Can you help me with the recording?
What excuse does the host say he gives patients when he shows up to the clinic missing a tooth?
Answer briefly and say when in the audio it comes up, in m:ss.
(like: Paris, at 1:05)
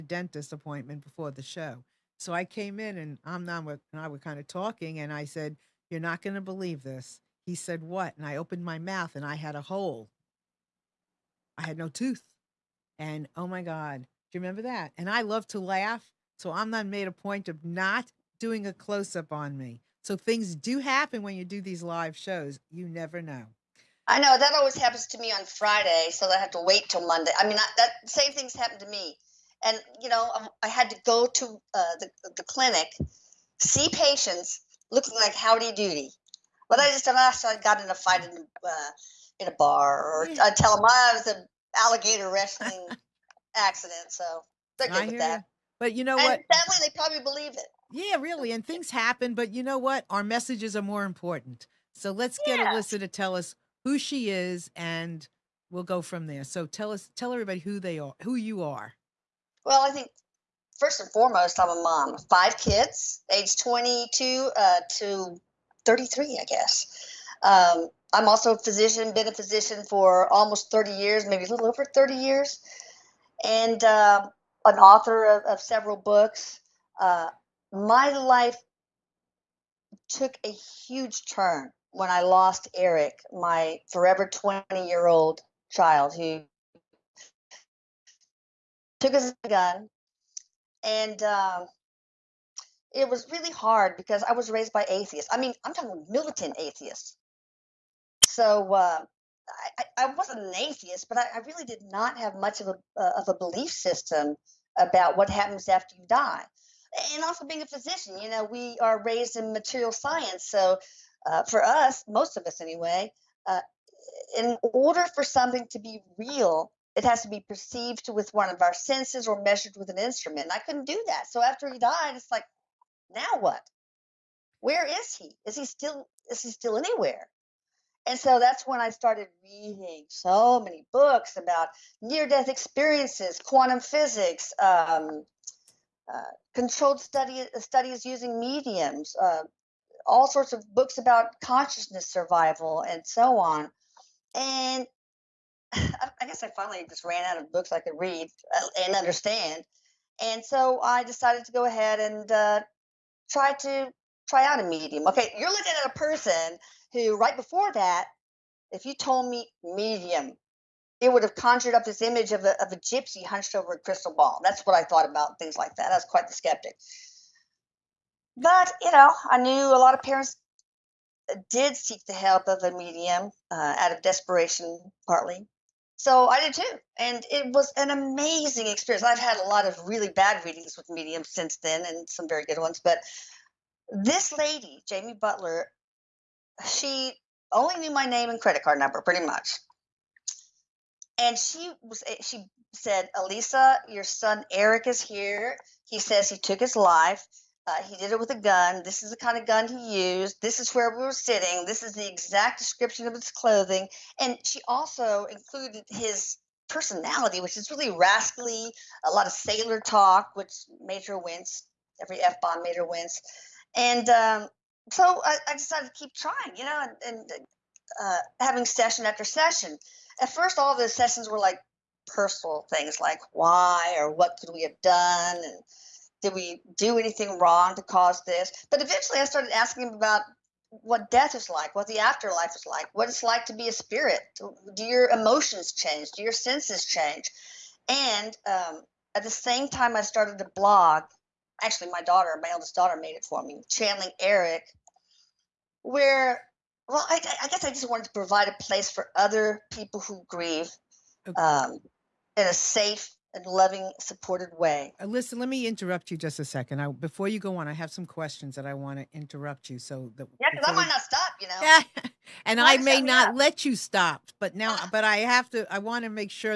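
Alligator wrestling accident, at 0:41.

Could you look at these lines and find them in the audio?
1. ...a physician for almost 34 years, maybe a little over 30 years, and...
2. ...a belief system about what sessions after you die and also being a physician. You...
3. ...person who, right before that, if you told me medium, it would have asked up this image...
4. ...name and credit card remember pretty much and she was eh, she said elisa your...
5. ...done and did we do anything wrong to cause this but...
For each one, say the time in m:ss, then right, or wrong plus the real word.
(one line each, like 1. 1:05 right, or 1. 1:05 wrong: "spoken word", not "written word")
1. 1:09 wrong: "30", not "34"
2. 1:43 wrong: "happens", not "sessions"
3. 2:35 wrong: "conjured", not "asked"
4. 3:08 wrong: "number", not "remember"
5. 3:44 right.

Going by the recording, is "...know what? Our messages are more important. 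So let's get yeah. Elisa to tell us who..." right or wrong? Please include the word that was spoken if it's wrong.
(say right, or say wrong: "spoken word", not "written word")
right.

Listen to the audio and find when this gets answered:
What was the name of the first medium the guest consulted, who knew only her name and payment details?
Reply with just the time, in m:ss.
3:04.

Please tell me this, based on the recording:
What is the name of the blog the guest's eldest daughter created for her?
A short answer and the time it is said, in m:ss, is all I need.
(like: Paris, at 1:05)
Channeling Erik, at 4:03.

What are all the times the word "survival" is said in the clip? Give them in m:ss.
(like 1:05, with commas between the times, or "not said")
2:22.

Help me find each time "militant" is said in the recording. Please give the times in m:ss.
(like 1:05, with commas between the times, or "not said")
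1:36.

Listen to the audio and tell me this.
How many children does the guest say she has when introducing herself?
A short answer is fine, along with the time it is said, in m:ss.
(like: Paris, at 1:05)
5, at 1:02.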